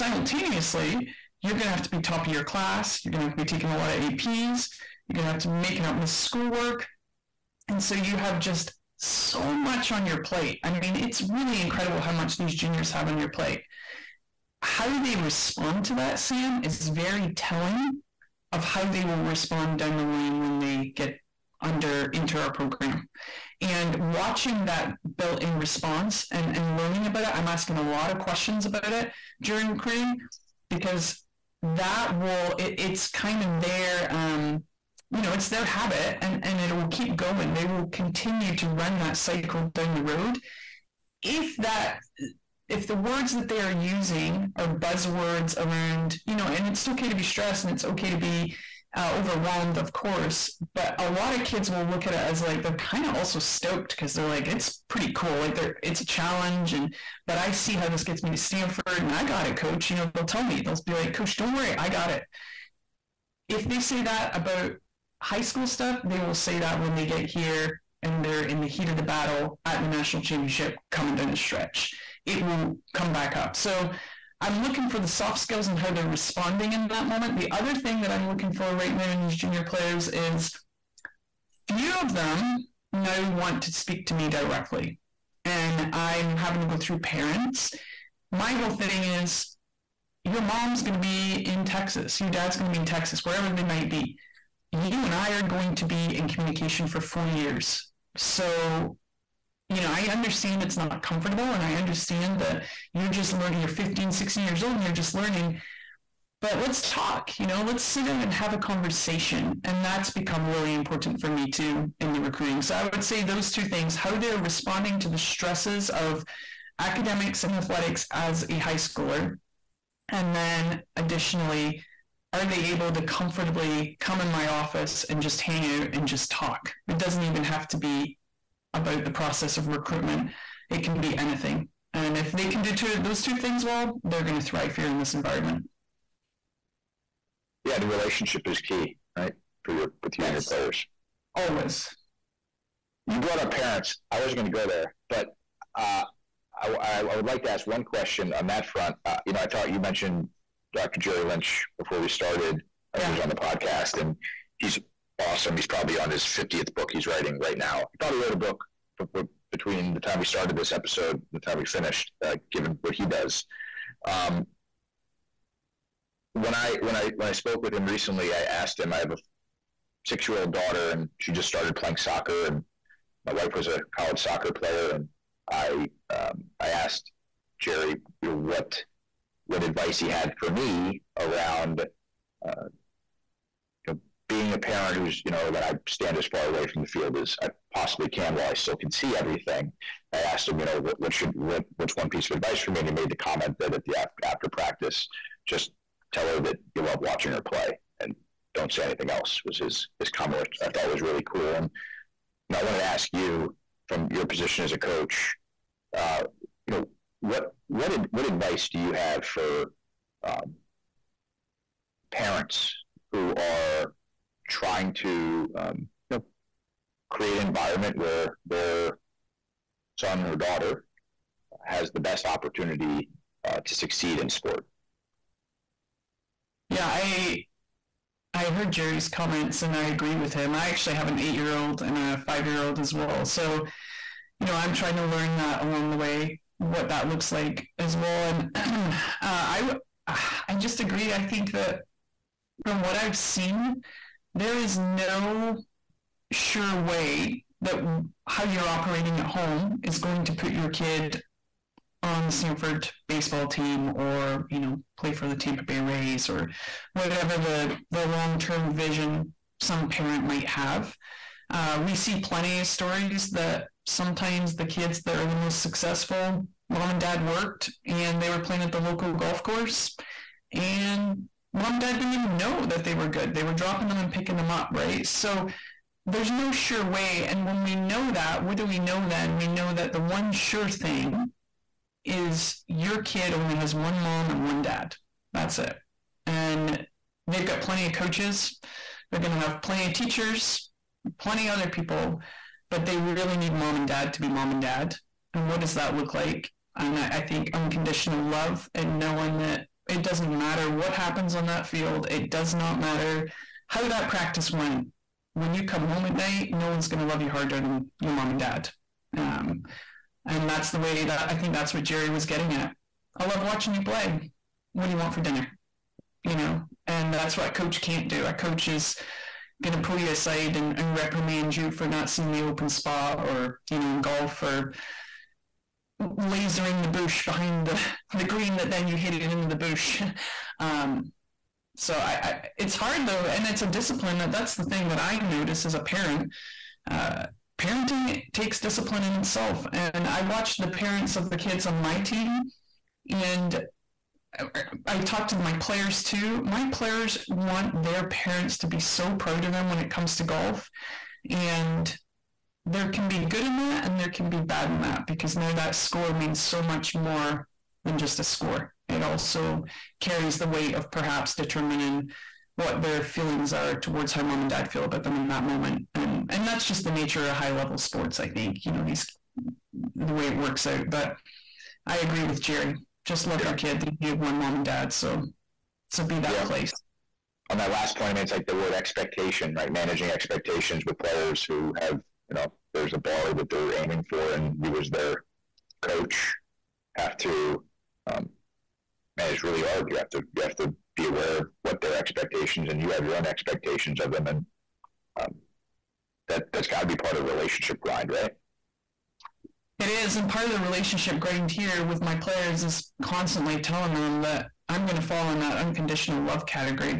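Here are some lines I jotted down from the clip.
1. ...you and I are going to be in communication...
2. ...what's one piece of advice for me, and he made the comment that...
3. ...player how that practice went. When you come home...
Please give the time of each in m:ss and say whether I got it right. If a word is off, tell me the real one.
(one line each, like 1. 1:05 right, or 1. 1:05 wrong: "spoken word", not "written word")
1. 1:34 right
2. 3:11 right
3. 5:02 wrong: "matter", not "player".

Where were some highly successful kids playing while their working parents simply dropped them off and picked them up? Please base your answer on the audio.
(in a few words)
the local golf course.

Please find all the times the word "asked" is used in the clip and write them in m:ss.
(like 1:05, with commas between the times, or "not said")
2:48, 2:56, 3:10.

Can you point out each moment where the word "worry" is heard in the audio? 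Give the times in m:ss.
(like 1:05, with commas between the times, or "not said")
1:01.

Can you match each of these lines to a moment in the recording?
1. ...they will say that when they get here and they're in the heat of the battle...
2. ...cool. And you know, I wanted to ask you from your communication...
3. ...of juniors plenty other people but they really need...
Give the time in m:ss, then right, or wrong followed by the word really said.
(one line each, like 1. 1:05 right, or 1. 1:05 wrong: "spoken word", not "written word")
1. 1:06 right
2. 3:21 wrong: "position", not "communication"
3. 4:49 wrong: "teachers", not "juniors".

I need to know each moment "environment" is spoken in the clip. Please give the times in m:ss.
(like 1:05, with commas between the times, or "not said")
2:15, 3:37.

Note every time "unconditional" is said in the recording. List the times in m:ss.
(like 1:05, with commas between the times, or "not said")
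4:57, 6:45.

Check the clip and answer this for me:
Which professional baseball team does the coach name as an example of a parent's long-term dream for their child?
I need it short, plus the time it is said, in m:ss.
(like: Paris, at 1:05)
Tampa Bay Rays, at 4:15.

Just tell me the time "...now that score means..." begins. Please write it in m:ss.
5:55.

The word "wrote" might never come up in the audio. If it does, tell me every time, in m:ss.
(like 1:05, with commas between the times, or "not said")
2:38.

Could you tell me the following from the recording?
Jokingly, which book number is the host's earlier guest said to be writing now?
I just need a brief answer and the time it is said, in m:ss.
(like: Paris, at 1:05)
50th, at 2:36.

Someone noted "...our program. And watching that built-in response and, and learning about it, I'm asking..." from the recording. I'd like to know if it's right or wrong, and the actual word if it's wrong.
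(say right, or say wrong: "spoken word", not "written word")
right.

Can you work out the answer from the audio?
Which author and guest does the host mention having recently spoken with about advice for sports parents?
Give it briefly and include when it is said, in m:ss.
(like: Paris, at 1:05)
Dr. Jerry Lynch, at 2:30.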